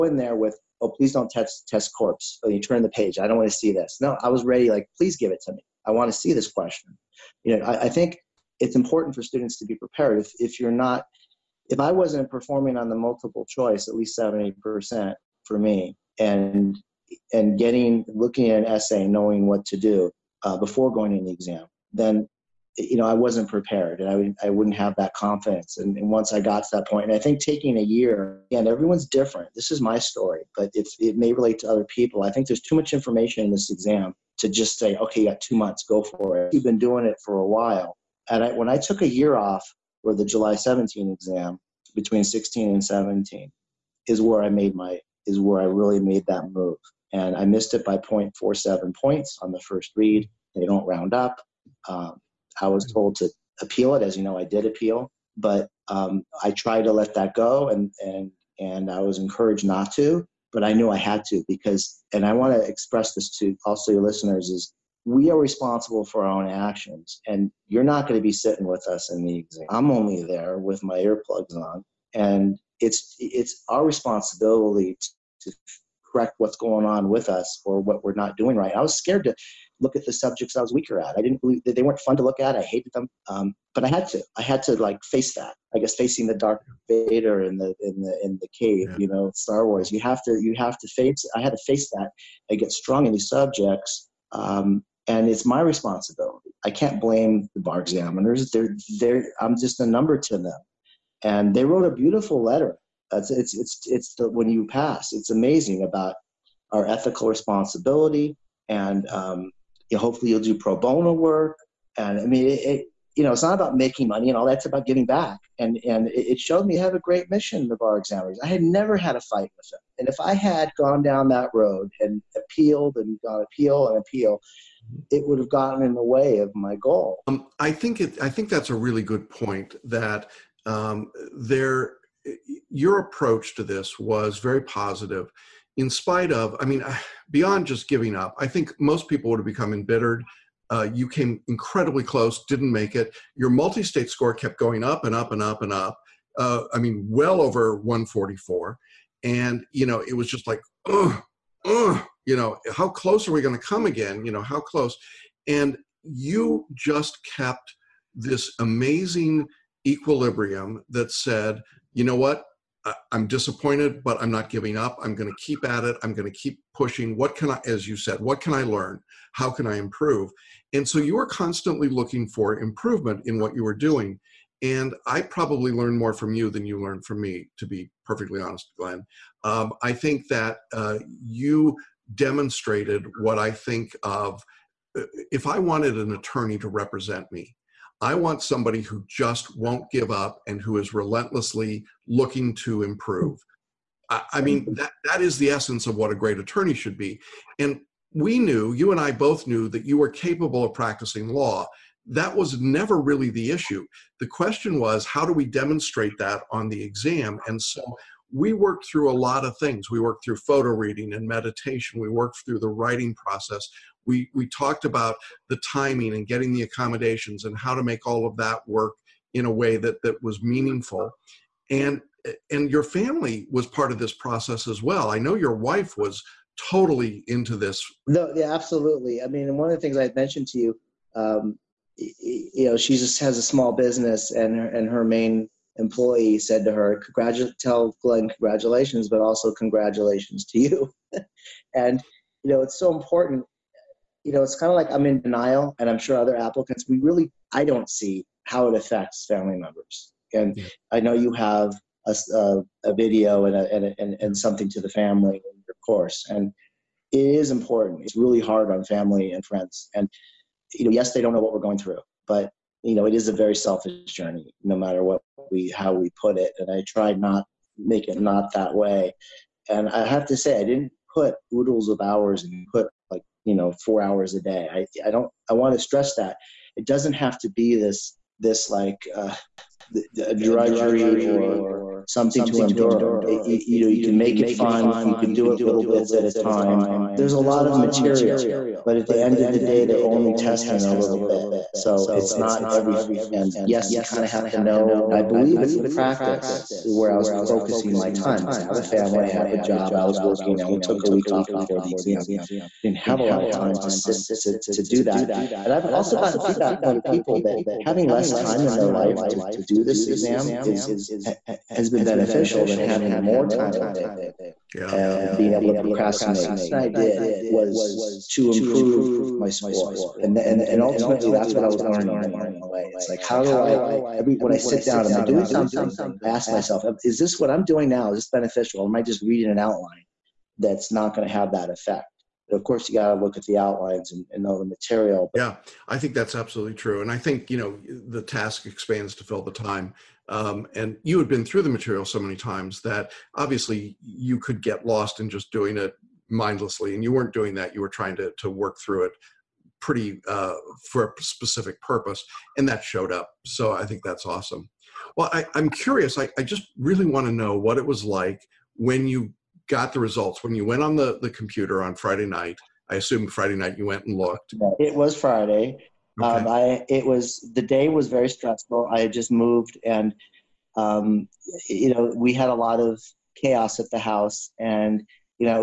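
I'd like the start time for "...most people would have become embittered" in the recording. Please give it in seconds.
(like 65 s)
138 s.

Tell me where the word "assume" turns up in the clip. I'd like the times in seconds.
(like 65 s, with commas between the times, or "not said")
362 s.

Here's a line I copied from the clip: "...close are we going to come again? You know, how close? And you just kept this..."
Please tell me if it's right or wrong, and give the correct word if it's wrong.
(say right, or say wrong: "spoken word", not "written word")
right.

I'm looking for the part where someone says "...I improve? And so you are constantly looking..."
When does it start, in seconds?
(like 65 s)
169 s.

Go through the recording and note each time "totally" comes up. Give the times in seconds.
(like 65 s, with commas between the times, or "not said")
226 s.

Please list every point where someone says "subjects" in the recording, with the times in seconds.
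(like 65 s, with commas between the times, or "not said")
80 s, 93 s.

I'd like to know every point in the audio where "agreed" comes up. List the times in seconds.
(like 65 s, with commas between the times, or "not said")
not said.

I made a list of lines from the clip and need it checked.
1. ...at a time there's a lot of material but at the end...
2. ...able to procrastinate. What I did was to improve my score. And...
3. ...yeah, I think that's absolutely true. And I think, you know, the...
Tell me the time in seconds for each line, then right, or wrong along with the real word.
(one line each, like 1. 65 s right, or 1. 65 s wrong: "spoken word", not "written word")
1. 286 s right
2. 315 s right
3. 335 s right.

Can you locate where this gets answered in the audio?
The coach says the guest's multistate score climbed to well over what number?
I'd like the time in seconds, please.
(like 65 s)
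147 s.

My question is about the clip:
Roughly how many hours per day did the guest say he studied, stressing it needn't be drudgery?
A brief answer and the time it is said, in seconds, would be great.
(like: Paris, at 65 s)
4 hours, at 273 s.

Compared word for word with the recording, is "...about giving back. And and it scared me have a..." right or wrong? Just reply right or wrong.
wrong.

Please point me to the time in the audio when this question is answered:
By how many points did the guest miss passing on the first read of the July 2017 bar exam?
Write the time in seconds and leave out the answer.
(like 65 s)
47 s.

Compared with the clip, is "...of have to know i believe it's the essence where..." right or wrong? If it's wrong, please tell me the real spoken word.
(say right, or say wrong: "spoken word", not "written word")
wrong: "practice", not "essence".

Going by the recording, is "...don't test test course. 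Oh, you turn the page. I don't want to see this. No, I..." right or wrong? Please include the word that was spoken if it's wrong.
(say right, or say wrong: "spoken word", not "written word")
wrong: "corpse", not "course".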